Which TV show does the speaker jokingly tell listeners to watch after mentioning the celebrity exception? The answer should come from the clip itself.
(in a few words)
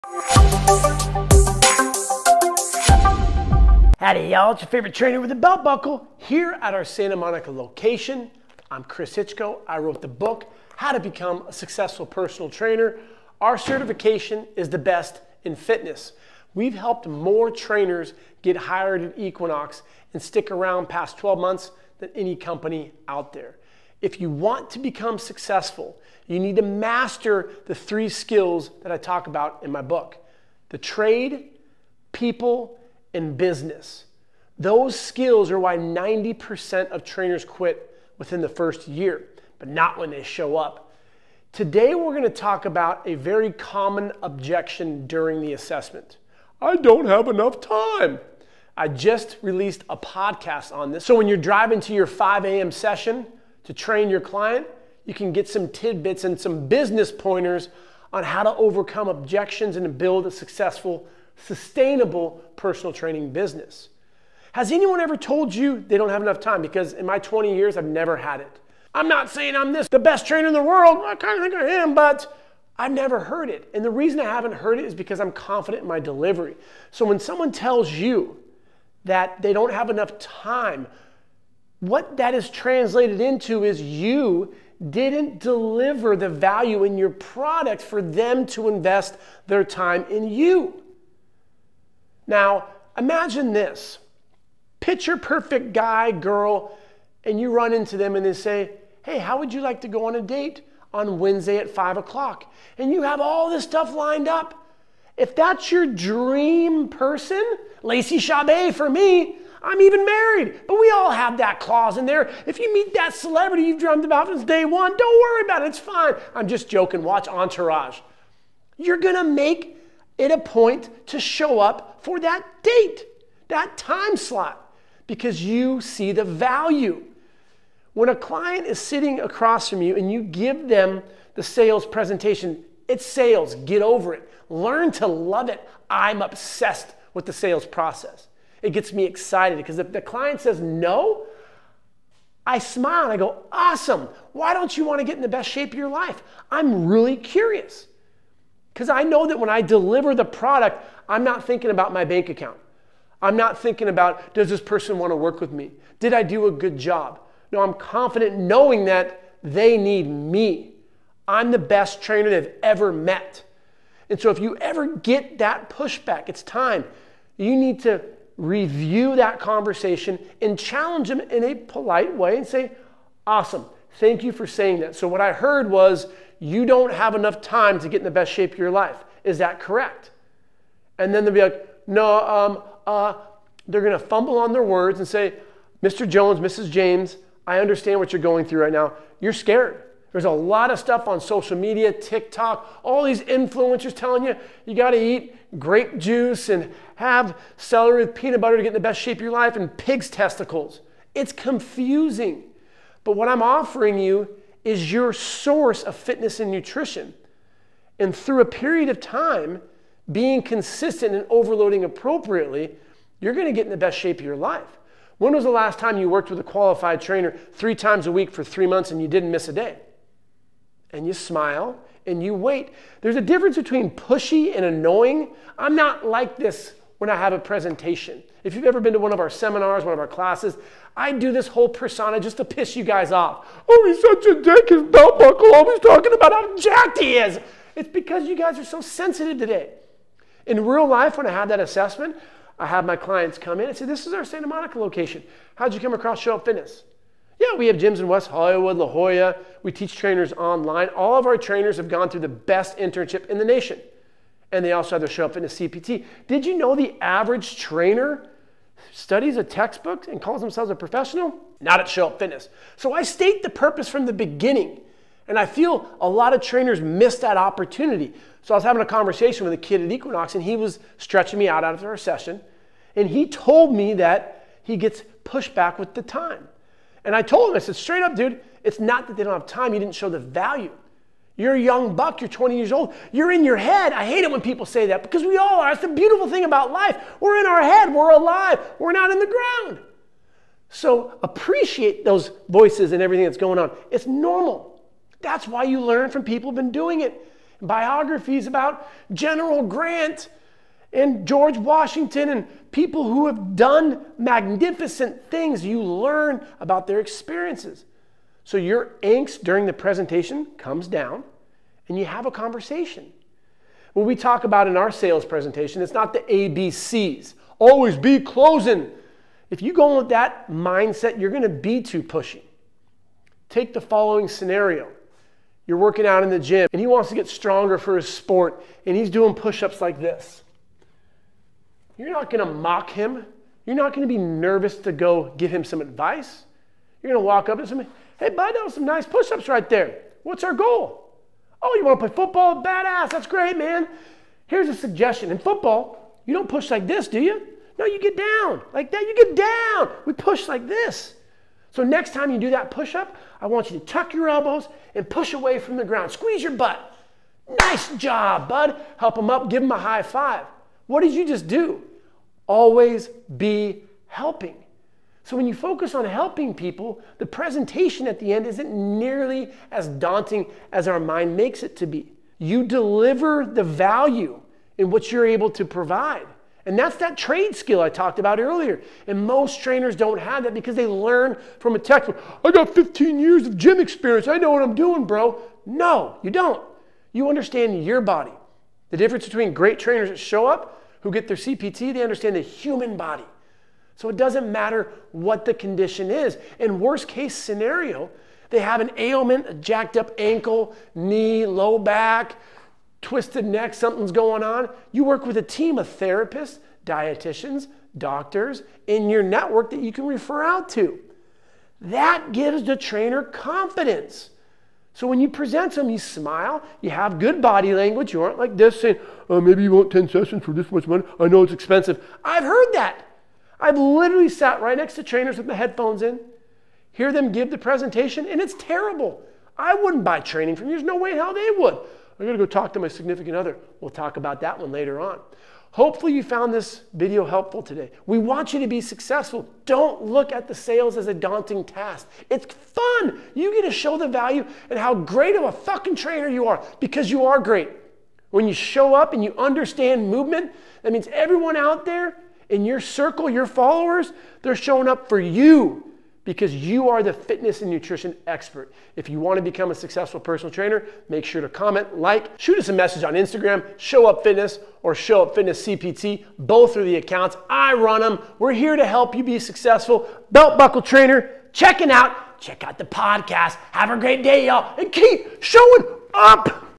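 Entourage.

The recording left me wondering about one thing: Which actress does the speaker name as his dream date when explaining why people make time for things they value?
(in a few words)
Lacey Chabert.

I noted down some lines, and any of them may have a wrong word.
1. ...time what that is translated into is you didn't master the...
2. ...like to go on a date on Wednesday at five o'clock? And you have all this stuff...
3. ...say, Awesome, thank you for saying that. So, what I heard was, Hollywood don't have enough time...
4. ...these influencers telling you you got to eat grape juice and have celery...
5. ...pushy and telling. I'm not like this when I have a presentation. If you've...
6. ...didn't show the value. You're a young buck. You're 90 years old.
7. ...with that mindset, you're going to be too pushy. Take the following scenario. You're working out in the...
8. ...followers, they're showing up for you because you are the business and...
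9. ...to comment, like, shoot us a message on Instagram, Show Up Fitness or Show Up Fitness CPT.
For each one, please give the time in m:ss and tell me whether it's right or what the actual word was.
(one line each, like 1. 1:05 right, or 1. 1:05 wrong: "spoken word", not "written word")
1. 1:20 wrong: "deliver", not "master"
2. 1:39 right
3. 2:52 wrong: "You", not "Hollywood"
4. 3:13 right
5. 3:43 wrong: "annoying", not "telling"
6. 4:39 wrong: "20", not "90"
7. 5:19 right
8. 7:33 wrong: "fitness", not "business"
9. 7:41 right.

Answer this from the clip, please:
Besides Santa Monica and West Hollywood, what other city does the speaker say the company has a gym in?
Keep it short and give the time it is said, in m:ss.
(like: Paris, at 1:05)
La Jolla, at 4:08.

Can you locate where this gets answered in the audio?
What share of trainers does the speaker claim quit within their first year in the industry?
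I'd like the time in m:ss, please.
0:35.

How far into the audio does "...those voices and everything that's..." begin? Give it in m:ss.
4:52.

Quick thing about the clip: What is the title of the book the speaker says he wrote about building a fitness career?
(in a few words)
How to Become a Successful Personal Trainer.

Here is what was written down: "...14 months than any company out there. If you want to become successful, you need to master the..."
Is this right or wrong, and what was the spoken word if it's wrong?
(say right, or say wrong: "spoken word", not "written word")
wrong: "12", not "14".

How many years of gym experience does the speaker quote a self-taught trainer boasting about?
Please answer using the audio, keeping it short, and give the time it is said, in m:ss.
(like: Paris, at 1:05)
15, at 6:22.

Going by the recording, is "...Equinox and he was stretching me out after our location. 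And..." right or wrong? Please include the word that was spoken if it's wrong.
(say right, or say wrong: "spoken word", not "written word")
wrong: "session", not "location".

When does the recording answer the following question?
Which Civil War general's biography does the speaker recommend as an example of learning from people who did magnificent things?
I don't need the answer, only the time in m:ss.
4:59.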